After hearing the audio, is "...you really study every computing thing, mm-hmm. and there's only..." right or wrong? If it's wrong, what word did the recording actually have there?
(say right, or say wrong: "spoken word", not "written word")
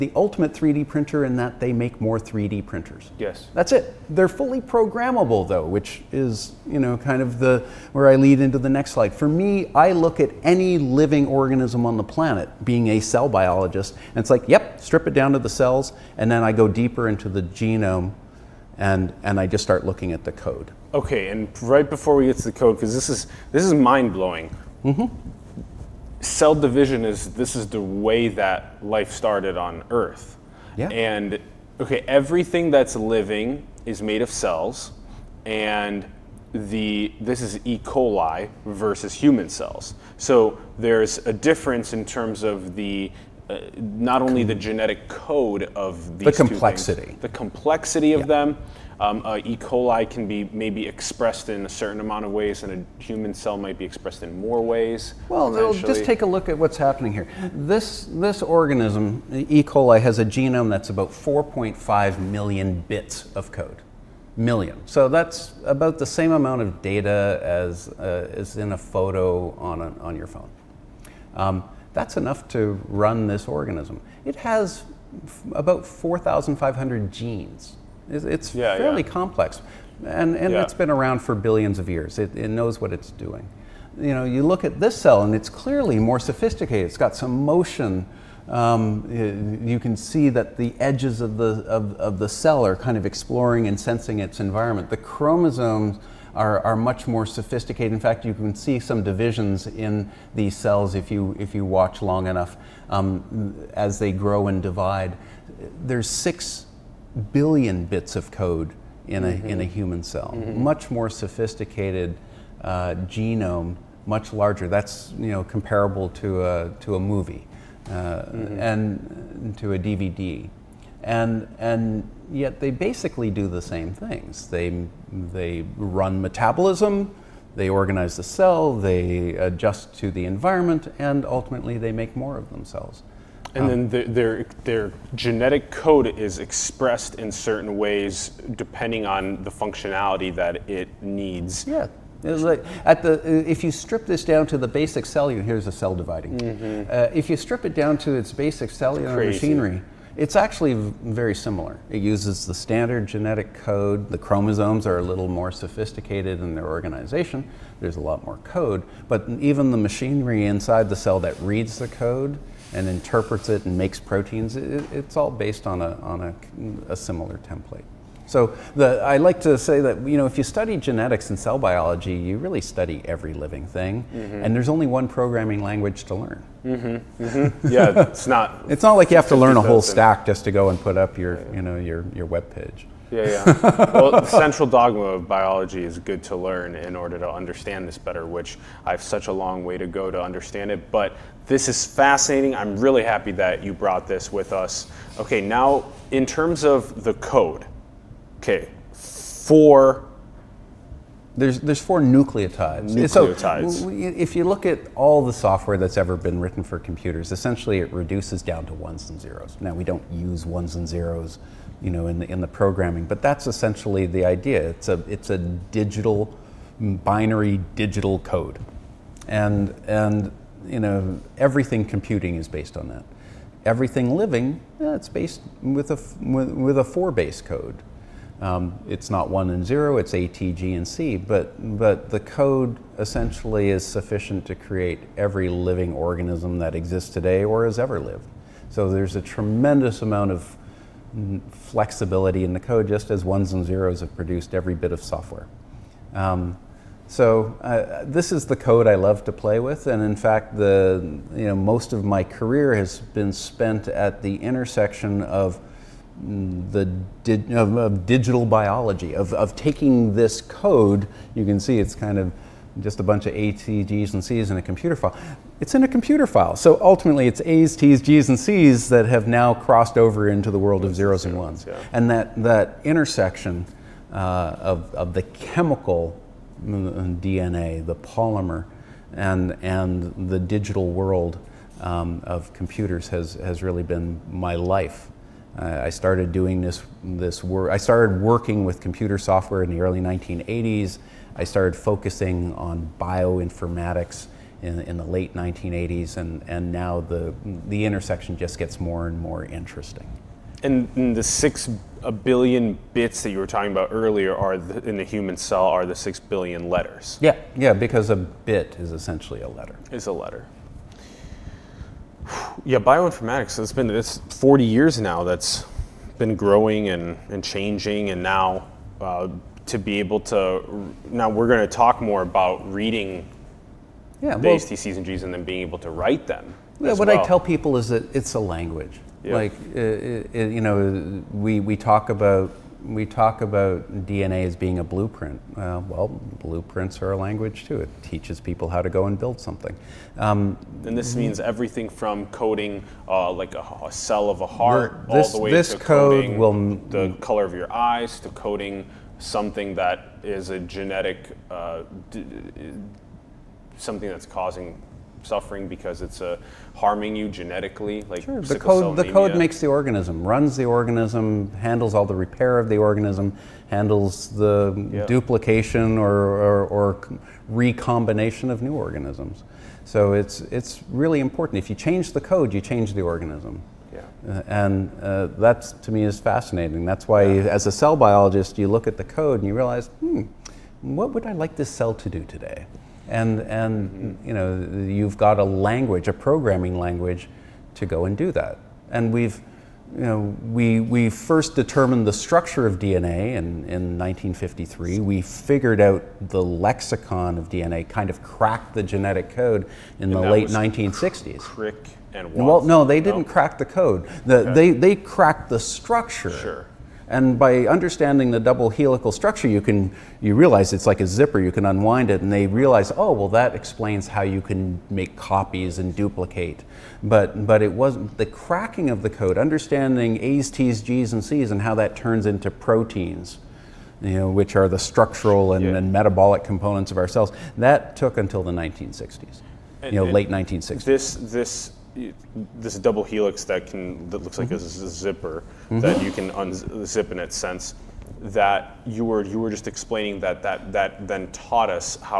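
wrong: "living", not "computing".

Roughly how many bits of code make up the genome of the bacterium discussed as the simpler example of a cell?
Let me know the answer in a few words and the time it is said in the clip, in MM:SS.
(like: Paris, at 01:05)
4.5 million, at 01:01.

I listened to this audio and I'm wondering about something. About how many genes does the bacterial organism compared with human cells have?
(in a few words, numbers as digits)
4,500.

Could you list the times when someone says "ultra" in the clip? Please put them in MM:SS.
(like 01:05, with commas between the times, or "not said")
not said.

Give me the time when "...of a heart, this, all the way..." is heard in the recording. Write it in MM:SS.
05:44.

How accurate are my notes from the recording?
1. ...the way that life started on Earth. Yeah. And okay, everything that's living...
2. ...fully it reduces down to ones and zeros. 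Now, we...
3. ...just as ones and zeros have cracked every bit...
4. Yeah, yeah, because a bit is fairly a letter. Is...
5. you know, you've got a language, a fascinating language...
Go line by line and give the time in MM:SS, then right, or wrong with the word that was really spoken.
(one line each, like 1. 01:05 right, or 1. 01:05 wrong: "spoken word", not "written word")
1. 00:27 right
2. 03:27 wrong: "essentially", not "fully"
3. 04:02 wrong: "produced", not "cracked"
4. 05:07 wrong: "essentially", not "fairly"
5. 06:24 wrong: "programming", not "fascinating".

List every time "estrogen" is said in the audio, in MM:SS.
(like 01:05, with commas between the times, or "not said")
not said.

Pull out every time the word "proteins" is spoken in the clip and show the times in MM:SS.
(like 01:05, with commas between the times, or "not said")
02:43, 07:02.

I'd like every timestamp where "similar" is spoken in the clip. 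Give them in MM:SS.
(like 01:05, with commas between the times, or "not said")
02:31, 02:46.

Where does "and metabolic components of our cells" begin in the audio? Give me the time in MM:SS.
07:05.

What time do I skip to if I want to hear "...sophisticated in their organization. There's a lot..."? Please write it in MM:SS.
02:35.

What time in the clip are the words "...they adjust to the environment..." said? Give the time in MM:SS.
02:08.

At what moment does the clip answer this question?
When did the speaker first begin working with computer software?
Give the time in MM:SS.
04:49.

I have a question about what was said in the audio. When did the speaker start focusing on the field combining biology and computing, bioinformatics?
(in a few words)
late 1980s.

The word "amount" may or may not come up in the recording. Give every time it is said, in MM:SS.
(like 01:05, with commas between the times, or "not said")
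00:51, 01:06, 04:00.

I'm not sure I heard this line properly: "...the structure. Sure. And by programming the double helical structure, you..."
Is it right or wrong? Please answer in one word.
wrong.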